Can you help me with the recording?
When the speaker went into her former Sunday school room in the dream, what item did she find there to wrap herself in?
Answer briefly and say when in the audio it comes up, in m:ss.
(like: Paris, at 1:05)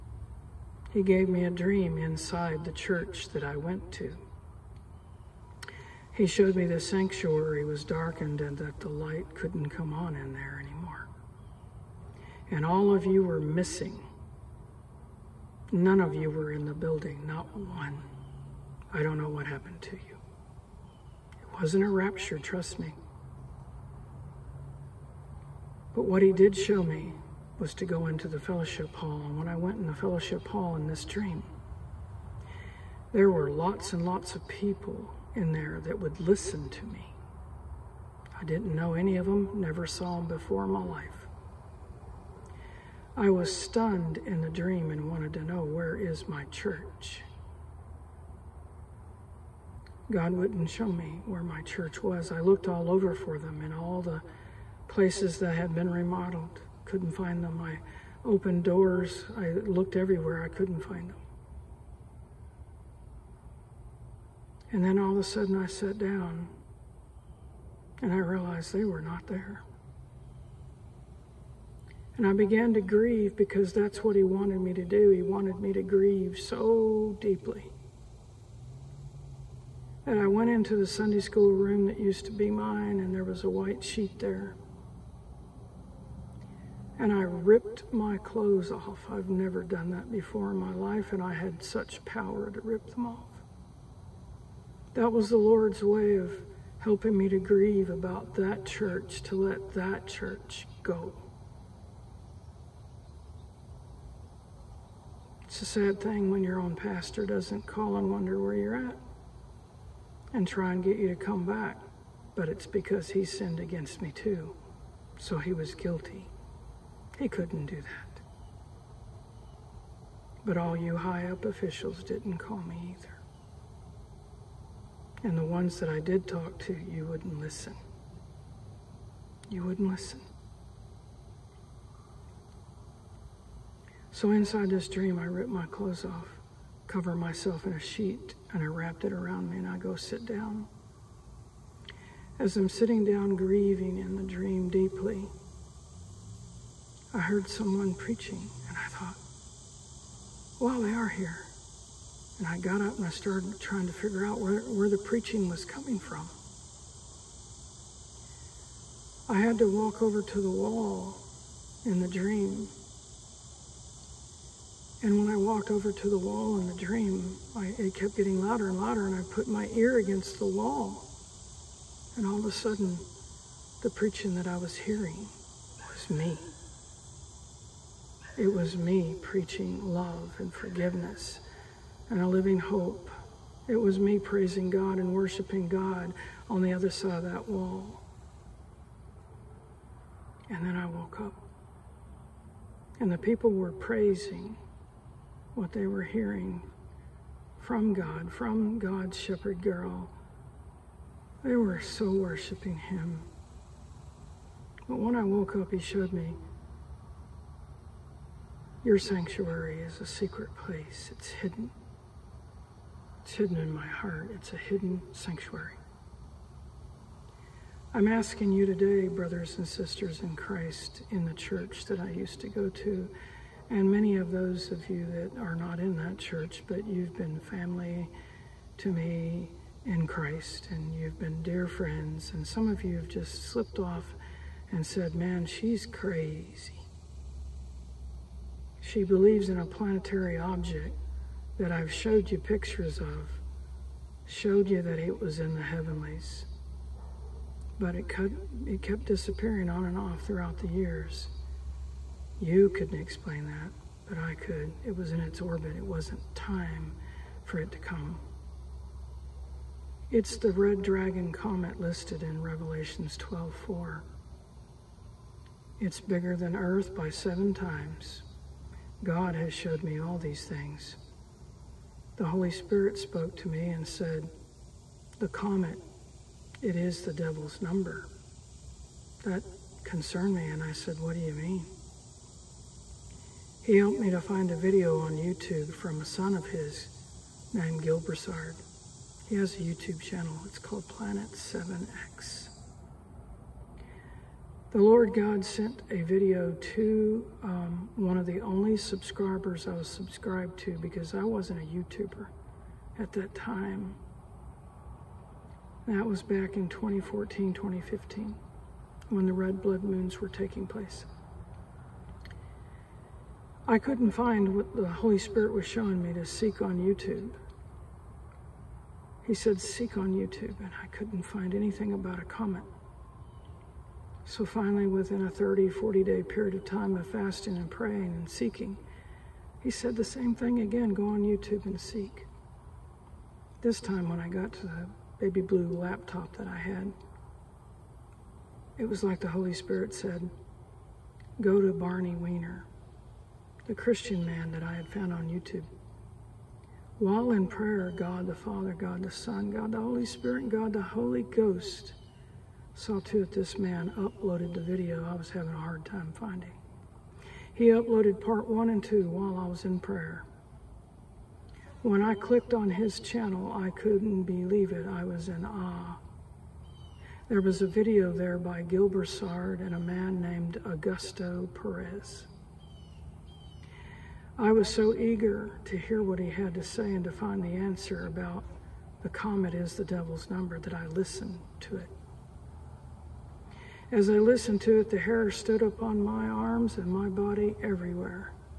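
white sheet, at 1:23.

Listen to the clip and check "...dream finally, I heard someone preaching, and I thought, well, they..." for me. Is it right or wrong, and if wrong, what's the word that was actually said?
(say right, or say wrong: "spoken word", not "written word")
wrong: "deeply", not "finally".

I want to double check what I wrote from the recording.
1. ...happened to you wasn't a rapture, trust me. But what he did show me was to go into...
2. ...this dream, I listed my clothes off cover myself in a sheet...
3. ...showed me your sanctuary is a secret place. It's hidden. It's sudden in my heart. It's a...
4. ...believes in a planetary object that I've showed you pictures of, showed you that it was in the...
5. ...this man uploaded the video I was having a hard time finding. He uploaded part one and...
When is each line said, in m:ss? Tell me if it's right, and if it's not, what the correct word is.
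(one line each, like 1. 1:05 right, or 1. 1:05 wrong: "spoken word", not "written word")
1. 0:19 right
2. 2:14 wrong: "ripped", not "listed"
3. 3:25 wrong: "hidden", not "sudden"
4. 3:59 right
5. 5:53 right.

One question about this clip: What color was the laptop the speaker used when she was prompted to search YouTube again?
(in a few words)
baby blue.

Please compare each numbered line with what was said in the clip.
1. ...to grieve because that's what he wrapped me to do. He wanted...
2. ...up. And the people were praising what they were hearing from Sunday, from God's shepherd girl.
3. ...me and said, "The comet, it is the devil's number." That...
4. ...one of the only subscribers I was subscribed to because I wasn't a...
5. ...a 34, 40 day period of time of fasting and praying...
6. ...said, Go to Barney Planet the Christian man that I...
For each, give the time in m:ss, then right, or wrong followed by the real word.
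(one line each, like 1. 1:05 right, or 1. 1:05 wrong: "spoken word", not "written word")
1. 1:12 wrong: "wanted", not "wrapped"
2. 3:11 wrong: "God", not "Sunday"
3. 4:33 right
4. 4:57 right
5. 5:25 wrong: "30", not "34"
6. 5:39 wrong: "Weiner", not "Planet".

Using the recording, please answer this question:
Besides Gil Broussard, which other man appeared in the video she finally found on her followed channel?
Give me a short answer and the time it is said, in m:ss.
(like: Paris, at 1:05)
Augusto Perez, at 6:10.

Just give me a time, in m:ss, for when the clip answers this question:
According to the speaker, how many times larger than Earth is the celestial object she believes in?
4:27.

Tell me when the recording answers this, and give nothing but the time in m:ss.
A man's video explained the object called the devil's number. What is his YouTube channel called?
4:50.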